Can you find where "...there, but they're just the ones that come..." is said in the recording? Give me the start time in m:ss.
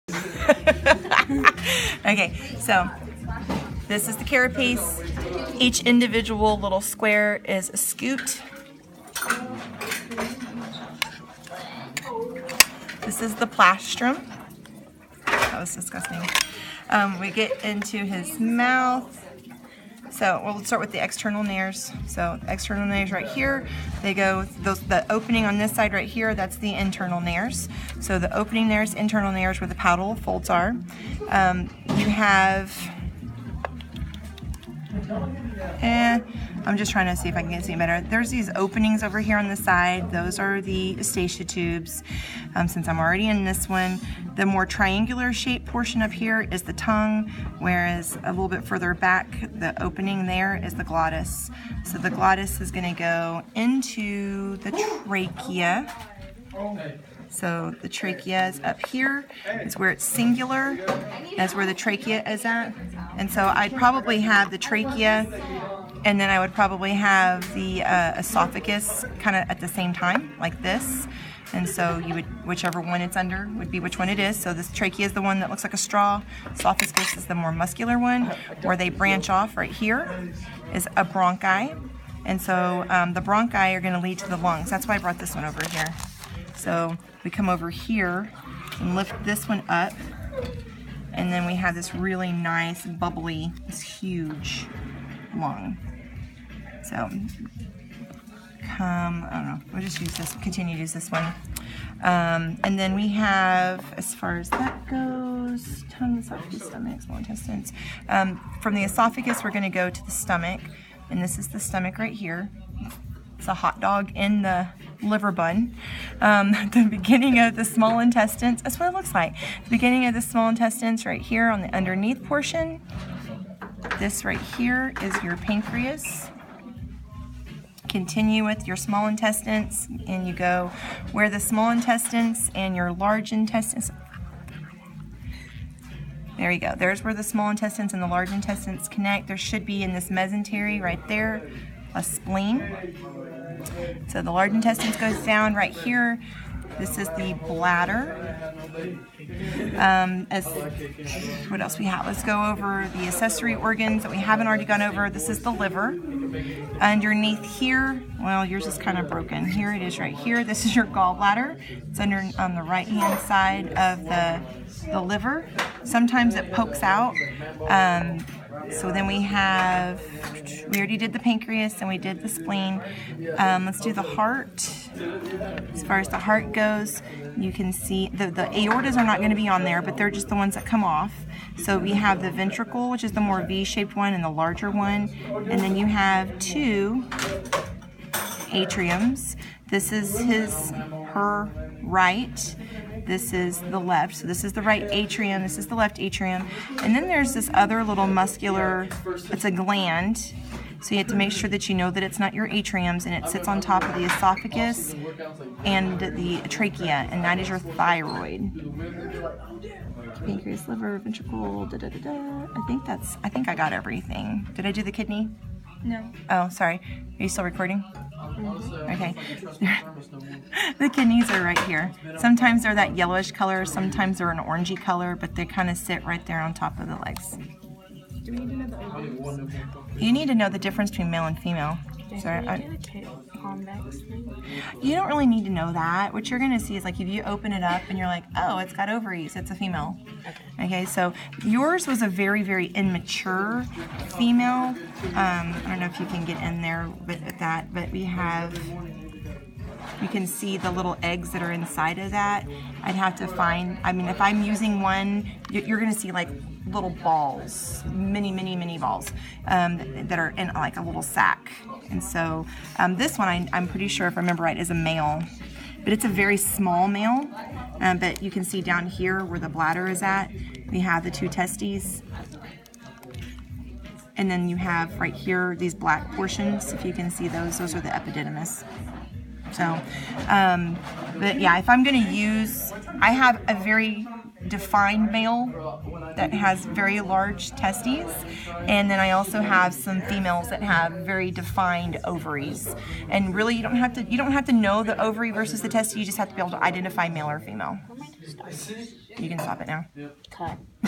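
2:59.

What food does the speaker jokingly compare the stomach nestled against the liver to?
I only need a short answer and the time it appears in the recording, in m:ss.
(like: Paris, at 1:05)
hot dog, at 1:53.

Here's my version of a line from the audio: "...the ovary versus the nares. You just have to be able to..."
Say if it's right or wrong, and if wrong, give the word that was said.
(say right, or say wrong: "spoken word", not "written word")
wrong: "testes", not "nares".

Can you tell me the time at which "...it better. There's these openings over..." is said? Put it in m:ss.
0:37.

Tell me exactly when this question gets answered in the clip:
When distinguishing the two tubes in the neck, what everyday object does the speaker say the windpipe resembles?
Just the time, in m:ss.
1:15.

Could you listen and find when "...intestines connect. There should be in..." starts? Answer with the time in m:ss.
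2:18.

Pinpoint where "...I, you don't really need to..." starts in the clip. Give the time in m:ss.
3:52.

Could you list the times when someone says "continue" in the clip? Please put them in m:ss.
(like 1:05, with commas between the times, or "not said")
1:40, 2:07.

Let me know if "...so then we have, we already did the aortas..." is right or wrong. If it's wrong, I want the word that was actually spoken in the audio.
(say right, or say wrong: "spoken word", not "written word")
wrong: "pancreas", not "aortas".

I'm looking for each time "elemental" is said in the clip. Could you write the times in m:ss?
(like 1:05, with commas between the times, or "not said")
not said.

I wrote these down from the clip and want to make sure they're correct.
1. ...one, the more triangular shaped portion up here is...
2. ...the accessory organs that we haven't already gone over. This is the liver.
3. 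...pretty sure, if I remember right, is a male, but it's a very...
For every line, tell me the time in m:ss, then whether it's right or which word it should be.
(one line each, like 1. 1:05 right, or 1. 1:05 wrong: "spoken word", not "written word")
1. 0:43 right
2. 2:32 right
3. 4:23 right.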